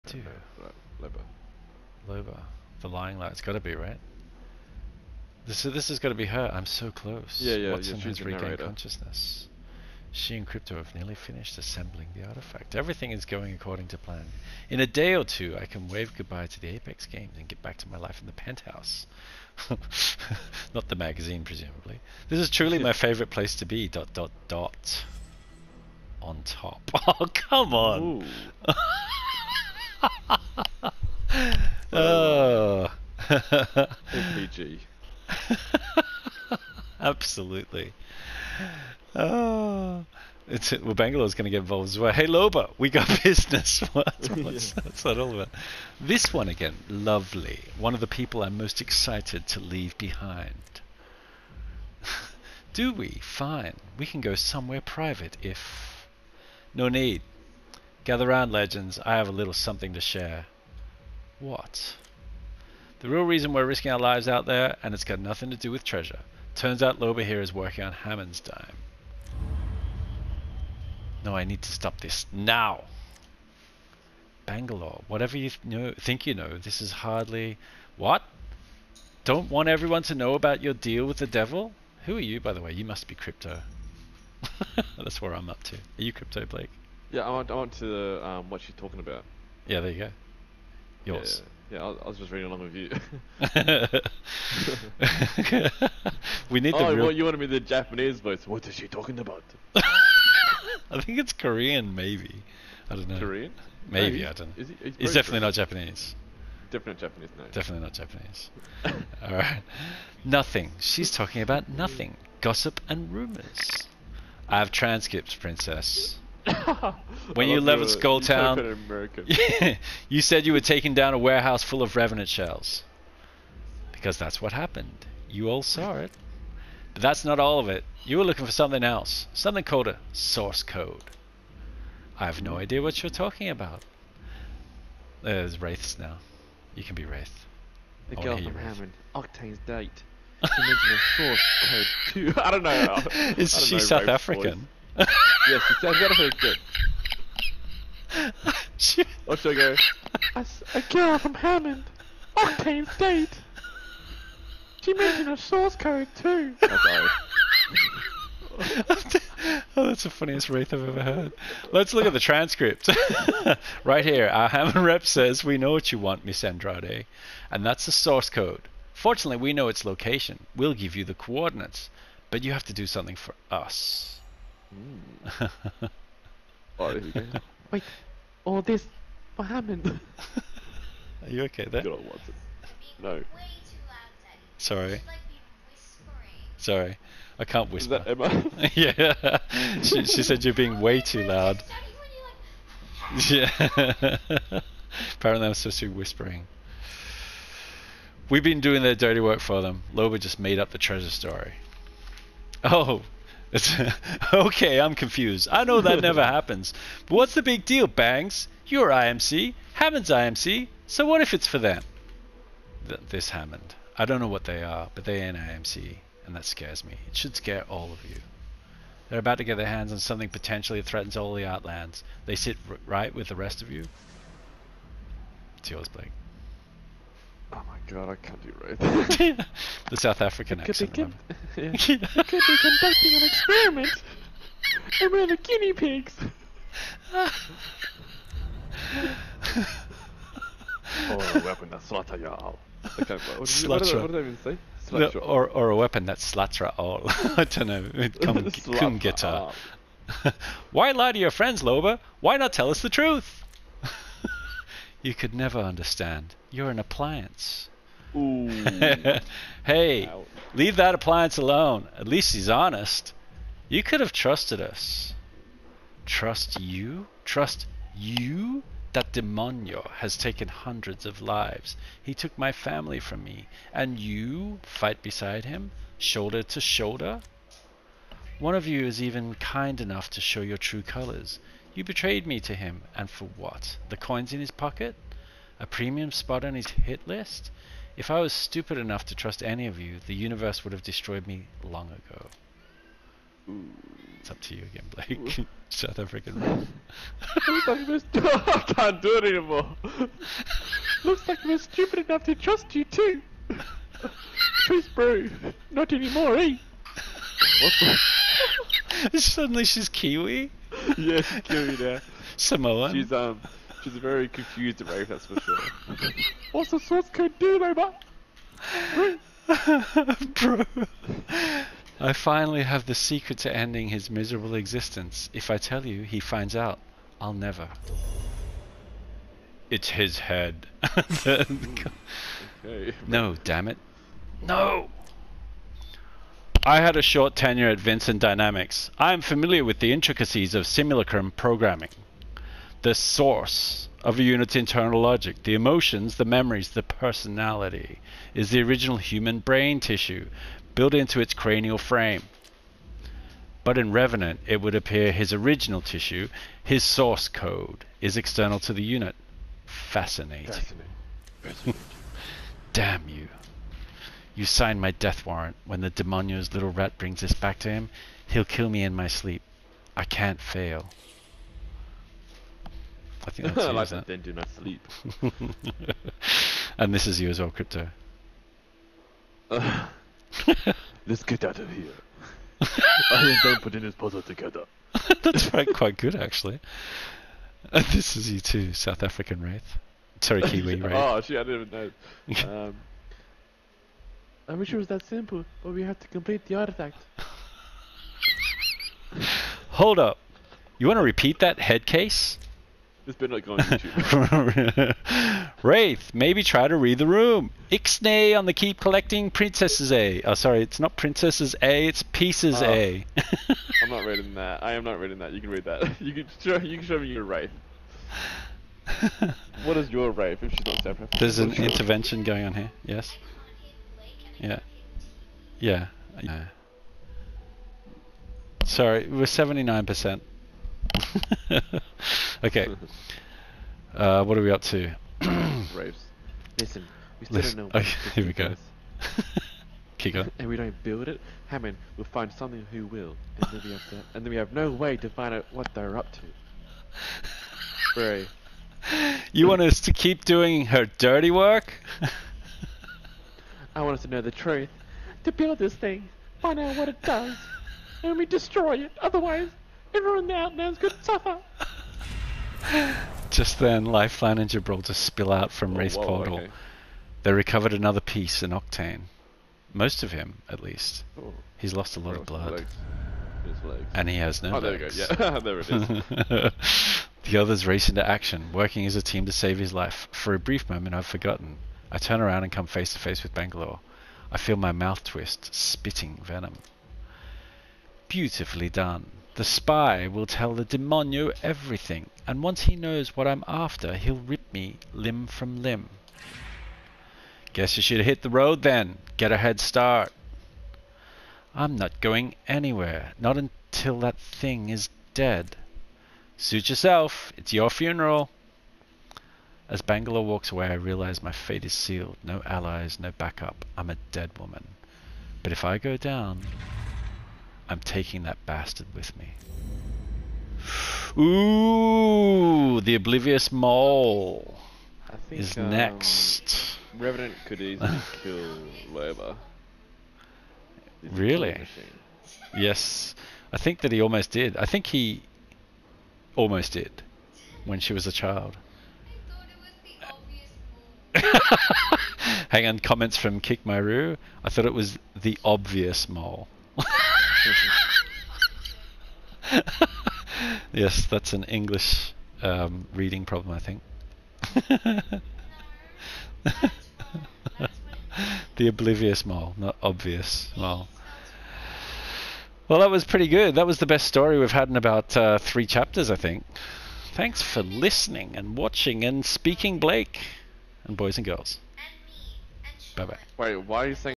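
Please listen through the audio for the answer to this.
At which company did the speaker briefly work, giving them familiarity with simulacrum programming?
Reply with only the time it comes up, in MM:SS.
05:37.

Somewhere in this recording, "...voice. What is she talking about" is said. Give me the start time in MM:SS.
01:38.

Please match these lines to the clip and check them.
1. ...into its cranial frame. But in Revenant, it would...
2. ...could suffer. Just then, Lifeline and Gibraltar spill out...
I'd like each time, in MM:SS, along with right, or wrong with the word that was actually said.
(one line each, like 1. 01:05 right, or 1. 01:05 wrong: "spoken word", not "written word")
1. 05:50 right
2. 07:40 right.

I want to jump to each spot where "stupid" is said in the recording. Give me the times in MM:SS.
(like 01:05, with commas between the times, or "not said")
04:48, 05:01.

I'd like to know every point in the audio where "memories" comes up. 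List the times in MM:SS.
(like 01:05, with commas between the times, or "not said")
05:46.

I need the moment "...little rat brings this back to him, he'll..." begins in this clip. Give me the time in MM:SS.
06:06.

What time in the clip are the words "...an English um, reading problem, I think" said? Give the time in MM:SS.
09:11.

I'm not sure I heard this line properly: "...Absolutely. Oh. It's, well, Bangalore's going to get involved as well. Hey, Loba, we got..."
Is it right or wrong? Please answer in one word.
right.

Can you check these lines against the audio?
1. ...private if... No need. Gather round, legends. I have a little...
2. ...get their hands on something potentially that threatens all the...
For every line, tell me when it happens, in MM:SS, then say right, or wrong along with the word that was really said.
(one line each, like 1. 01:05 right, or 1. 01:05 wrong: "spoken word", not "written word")
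1. 00:54 right
2. 03:39 right.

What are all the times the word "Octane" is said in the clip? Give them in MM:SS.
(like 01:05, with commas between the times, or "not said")
02:19, 02:32, 07:48.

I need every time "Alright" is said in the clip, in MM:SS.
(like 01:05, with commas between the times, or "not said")
01:49.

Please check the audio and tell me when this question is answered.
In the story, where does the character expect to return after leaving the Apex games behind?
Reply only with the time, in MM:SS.
00:18.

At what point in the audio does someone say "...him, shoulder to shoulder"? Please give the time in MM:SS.
04:35.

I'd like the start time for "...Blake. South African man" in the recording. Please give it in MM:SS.
04:54.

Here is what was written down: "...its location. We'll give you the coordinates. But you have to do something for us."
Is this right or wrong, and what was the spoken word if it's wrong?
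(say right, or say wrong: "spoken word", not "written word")
right.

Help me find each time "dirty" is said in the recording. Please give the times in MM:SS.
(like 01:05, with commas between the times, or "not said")
03:18, 07:30.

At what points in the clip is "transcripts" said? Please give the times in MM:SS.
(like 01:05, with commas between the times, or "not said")
01:54, 02:42.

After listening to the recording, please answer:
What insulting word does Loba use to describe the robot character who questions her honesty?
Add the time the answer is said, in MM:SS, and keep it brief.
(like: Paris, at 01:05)
An appliance, at 04:16.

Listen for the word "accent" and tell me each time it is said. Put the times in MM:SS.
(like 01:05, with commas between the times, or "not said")
03:50.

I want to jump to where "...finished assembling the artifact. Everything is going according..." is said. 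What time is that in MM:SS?
00:11.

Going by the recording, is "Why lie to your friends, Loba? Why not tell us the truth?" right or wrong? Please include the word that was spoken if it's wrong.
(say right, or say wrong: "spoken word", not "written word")
right.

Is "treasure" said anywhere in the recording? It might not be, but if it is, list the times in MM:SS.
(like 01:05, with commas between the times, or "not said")
01:05, 03:20.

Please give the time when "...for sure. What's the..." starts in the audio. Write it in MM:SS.
05:15.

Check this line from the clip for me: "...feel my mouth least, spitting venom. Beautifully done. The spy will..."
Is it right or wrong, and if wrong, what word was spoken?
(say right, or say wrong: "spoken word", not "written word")
wrong: "twist", not "least".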